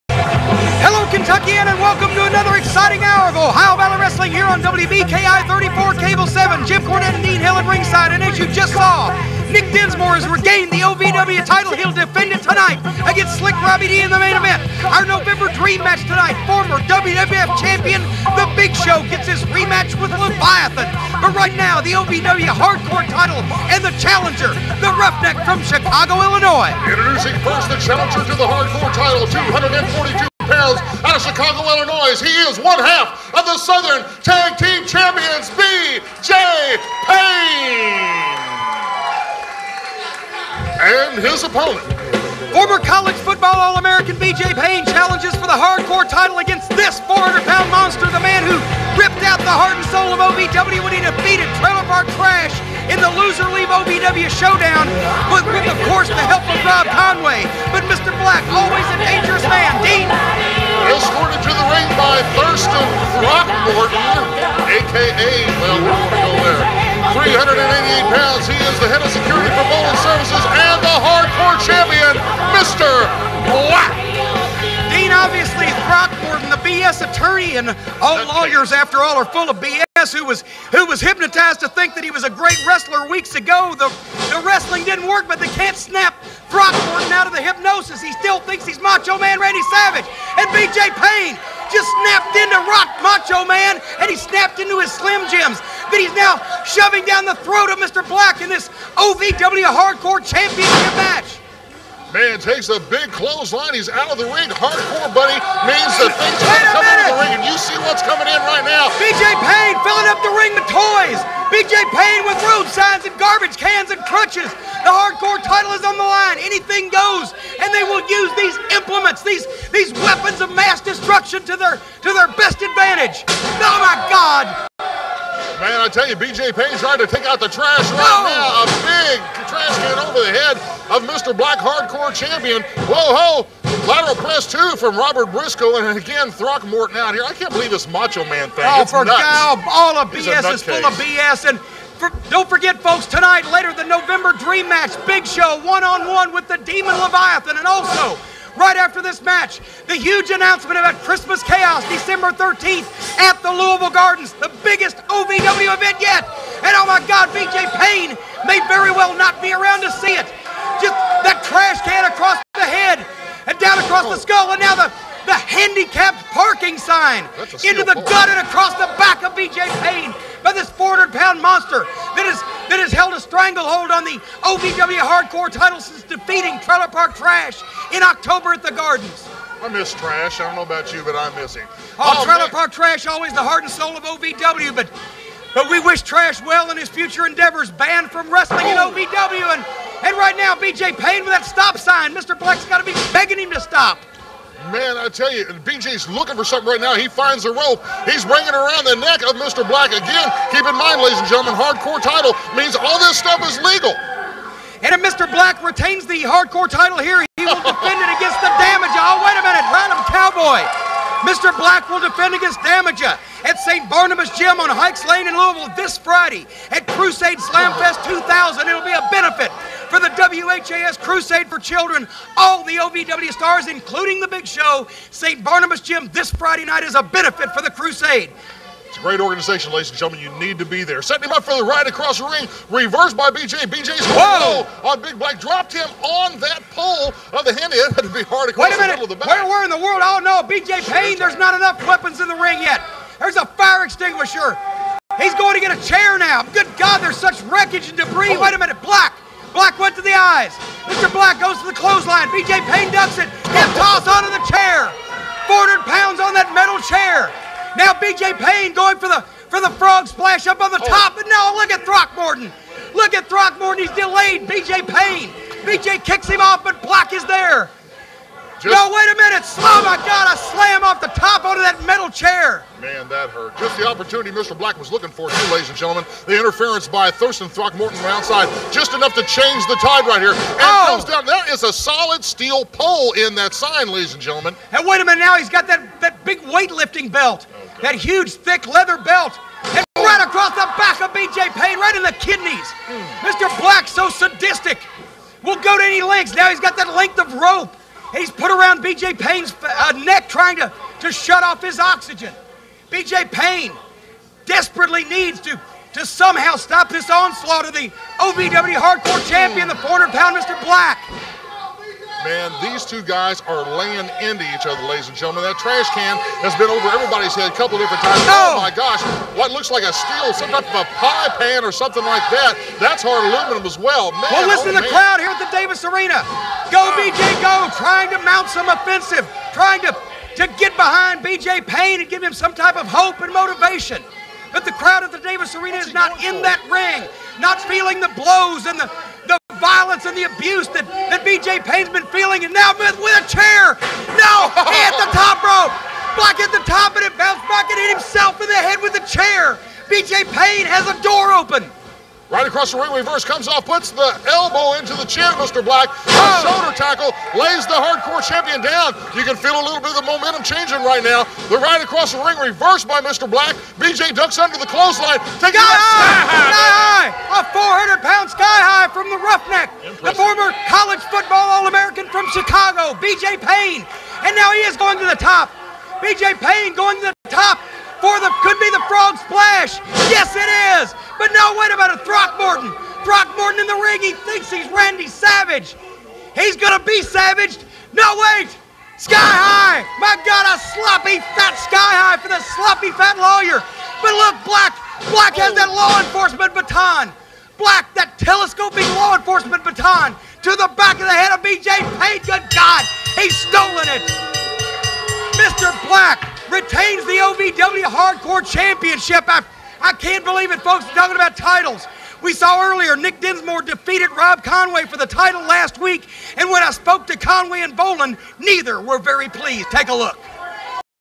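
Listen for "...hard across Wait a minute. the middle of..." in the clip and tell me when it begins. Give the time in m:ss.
3:58.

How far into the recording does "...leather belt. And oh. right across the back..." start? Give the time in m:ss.
4:48.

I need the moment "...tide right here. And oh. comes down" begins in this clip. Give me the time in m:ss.
4:39.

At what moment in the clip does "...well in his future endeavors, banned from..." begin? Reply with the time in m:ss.
3:06.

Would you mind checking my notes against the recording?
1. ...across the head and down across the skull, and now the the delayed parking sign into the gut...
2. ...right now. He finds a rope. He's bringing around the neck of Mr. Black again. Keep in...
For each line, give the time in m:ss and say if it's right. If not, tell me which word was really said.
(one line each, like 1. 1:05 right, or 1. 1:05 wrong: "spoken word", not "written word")
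1. 2:42 wrong: "handicapped", not "delayed"
2. 3:16 right.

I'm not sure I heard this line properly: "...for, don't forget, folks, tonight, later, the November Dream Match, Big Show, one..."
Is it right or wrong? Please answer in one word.
right.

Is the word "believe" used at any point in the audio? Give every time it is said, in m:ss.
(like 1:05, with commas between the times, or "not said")
2:17, 6:50.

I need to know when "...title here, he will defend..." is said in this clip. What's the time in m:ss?
3:26.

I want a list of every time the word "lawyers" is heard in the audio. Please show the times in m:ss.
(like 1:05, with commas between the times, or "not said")
1:18, 6:33.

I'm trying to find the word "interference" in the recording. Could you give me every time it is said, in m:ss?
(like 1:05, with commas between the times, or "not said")
4:36.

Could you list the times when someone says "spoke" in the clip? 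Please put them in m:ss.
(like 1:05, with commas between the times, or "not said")
6:56.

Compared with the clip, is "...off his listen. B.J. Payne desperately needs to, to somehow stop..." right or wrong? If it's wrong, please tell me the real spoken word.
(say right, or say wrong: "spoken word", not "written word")
wrong: "oxygen", not "listen".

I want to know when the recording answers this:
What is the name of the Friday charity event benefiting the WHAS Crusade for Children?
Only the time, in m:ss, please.
3:36.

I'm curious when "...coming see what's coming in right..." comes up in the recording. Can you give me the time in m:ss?
1:46.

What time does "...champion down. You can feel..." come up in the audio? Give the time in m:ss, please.
5:58.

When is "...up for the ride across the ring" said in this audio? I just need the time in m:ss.
3:51.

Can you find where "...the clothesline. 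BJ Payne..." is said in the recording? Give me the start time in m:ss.
4:11.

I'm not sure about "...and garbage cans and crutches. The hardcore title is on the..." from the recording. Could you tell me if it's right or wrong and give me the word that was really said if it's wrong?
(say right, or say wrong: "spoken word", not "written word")
right.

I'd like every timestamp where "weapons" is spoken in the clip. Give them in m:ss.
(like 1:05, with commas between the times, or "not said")
2:00, 4:01.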